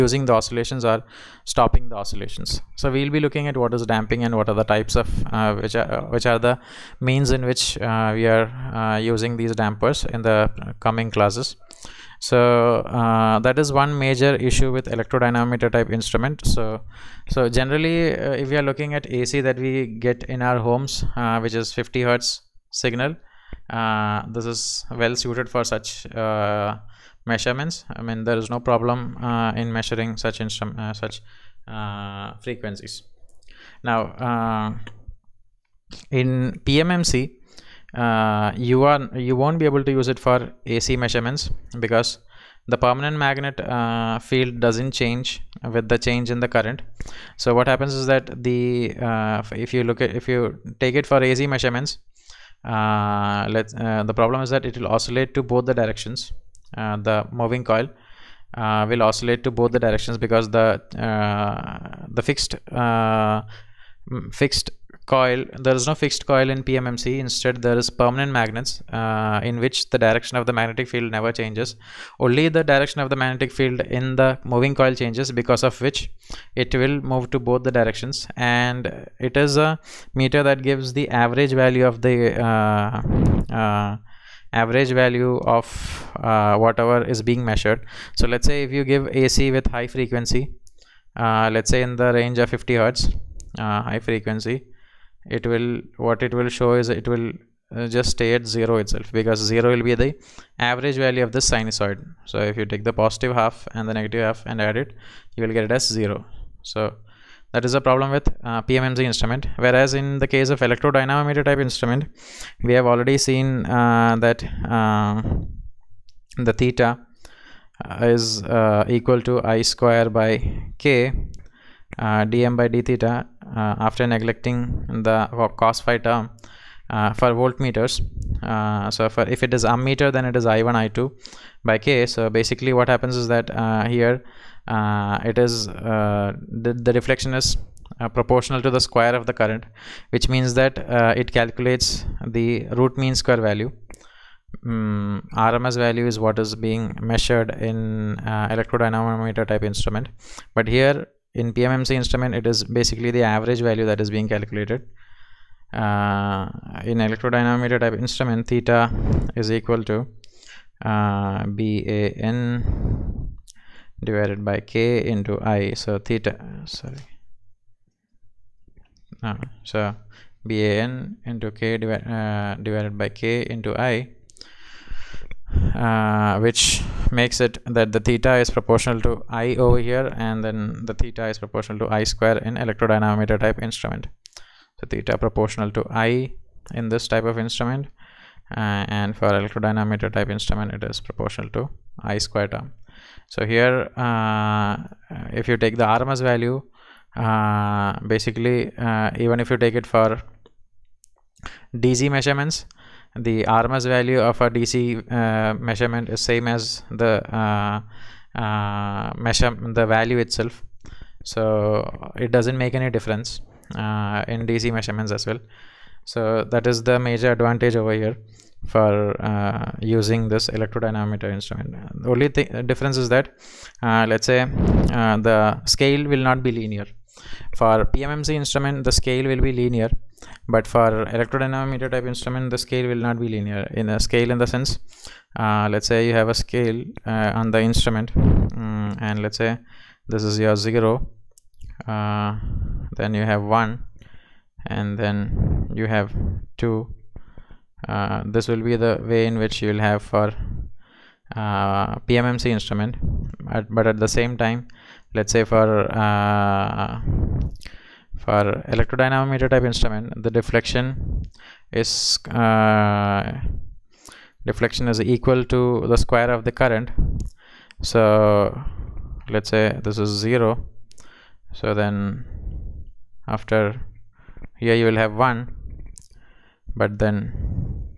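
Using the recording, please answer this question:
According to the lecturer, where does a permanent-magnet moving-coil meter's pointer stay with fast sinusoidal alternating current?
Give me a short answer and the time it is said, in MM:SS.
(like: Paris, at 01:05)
0, at 01:37.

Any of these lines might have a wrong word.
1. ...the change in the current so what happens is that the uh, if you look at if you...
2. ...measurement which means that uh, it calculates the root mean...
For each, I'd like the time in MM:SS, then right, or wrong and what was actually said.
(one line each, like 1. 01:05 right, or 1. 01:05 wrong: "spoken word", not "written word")
1. 00:45 right
2. 02:19 wrong: "current", not "measurement".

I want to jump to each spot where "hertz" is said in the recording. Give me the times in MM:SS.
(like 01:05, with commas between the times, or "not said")
00:22, 01:32.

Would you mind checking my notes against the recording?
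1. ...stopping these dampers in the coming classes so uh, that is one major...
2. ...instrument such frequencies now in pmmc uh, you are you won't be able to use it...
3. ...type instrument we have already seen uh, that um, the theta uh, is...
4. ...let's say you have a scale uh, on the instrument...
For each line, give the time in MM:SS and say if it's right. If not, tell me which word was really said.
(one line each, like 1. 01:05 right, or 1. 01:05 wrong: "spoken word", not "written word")
1. 00:09 wrong: "using", not "stopping"
2. 00:30 right
3. 01:51 right
4. 03:55 right.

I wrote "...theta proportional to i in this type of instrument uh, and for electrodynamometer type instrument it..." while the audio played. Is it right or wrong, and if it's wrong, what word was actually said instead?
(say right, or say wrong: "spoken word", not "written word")
right.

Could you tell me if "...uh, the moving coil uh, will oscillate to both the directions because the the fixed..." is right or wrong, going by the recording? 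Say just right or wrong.
right.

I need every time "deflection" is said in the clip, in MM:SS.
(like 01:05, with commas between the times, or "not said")
04:20, 04:24.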